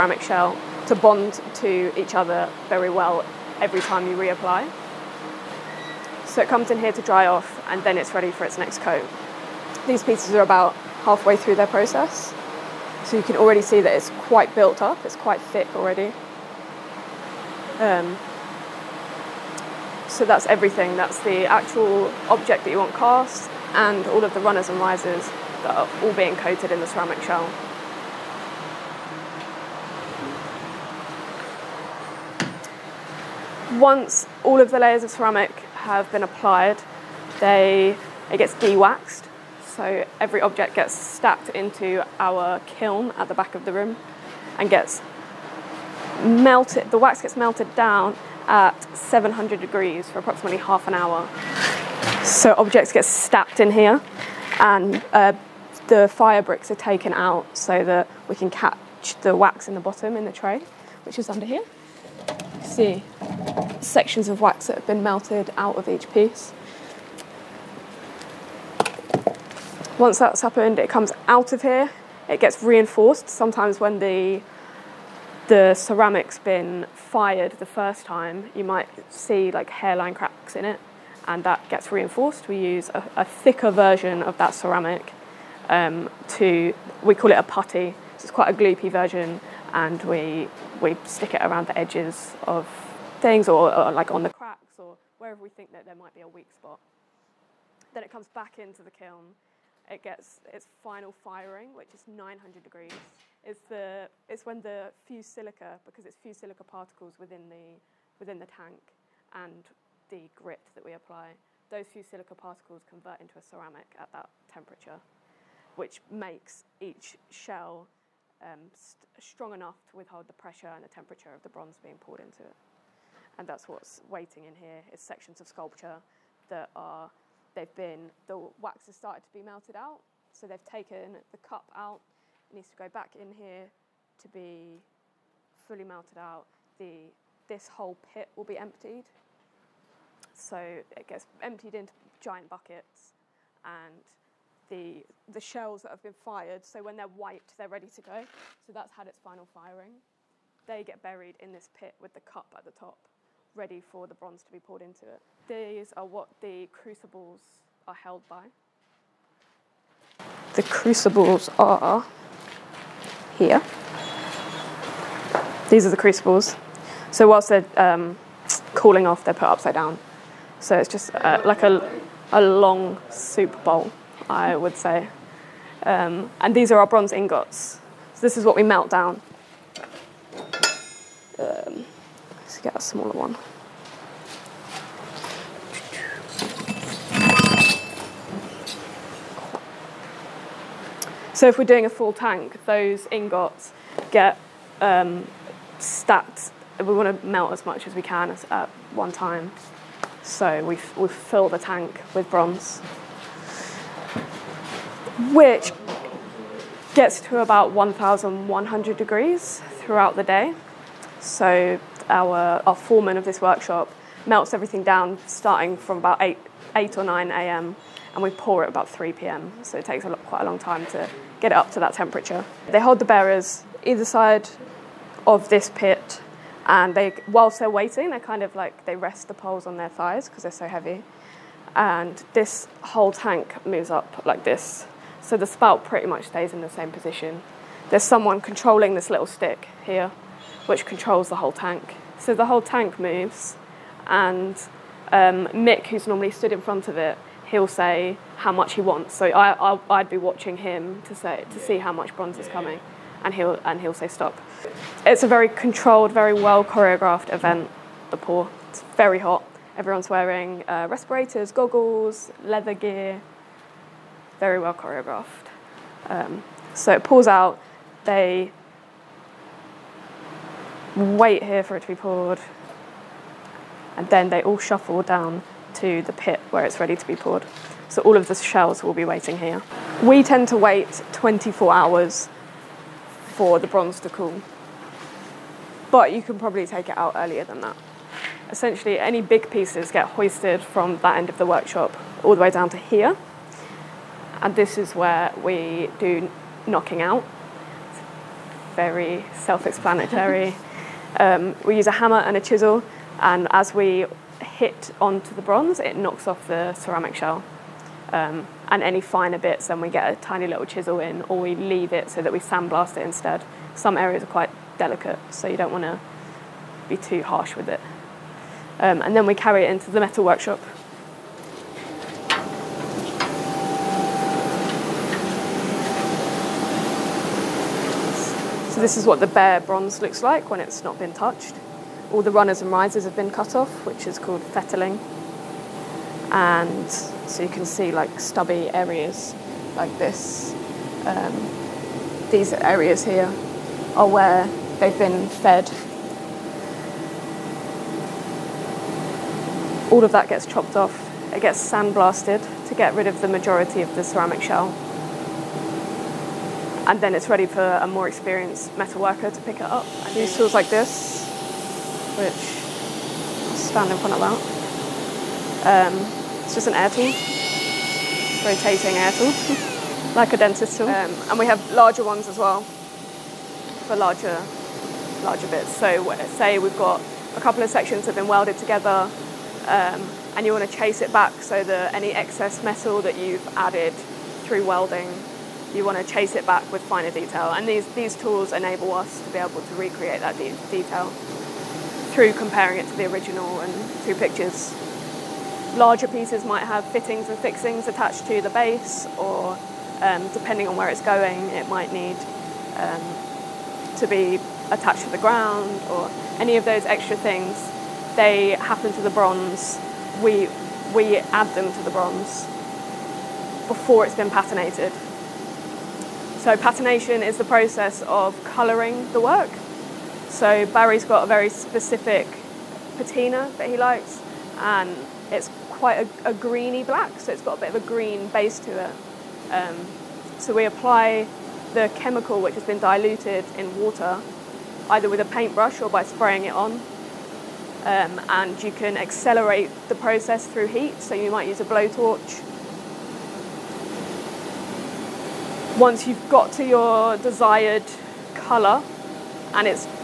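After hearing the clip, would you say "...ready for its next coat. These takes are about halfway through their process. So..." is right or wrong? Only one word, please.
wrong.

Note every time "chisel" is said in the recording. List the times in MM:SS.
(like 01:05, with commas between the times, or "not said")
05:02, 05:10.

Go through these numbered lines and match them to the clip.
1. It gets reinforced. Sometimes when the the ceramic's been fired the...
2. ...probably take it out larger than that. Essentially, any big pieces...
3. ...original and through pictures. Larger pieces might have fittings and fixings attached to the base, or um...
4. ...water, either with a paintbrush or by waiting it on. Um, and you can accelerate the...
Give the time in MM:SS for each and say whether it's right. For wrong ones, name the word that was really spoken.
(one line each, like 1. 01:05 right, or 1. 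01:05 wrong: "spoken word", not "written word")
1. 01:12 right
2. 04:46 wrong: "earlier", not "larger"
3. 06:33 right
4. 07:13 wrong: "spraying", not "waiting".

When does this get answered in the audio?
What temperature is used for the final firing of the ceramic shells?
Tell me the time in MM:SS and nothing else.
01:42.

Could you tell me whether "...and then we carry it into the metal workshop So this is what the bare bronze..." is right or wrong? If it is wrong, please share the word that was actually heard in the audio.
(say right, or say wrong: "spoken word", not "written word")
right.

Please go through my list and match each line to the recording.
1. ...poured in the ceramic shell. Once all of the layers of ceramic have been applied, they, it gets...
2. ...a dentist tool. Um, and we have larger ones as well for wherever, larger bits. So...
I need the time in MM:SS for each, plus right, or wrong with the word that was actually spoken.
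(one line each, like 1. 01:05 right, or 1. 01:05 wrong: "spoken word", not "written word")
1. 00:26 wrong: "coated", not "poured"
2. 06:10 wrong: "larger", not "wherever".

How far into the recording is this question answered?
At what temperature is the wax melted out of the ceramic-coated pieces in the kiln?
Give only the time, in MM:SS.
00:48.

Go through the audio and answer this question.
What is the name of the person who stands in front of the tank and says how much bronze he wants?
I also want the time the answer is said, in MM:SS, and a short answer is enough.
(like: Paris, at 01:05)
Mick, at 04:05.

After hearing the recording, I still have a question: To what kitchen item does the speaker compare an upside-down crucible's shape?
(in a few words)
a long soup bowl.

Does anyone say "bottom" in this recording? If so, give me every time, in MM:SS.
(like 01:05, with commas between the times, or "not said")
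00:59.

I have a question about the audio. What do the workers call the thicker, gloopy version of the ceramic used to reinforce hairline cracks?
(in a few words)
putty.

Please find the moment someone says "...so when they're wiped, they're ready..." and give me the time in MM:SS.
02:26.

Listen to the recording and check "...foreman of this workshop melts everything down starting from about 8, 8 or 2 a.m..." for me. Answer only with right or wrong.
wrong.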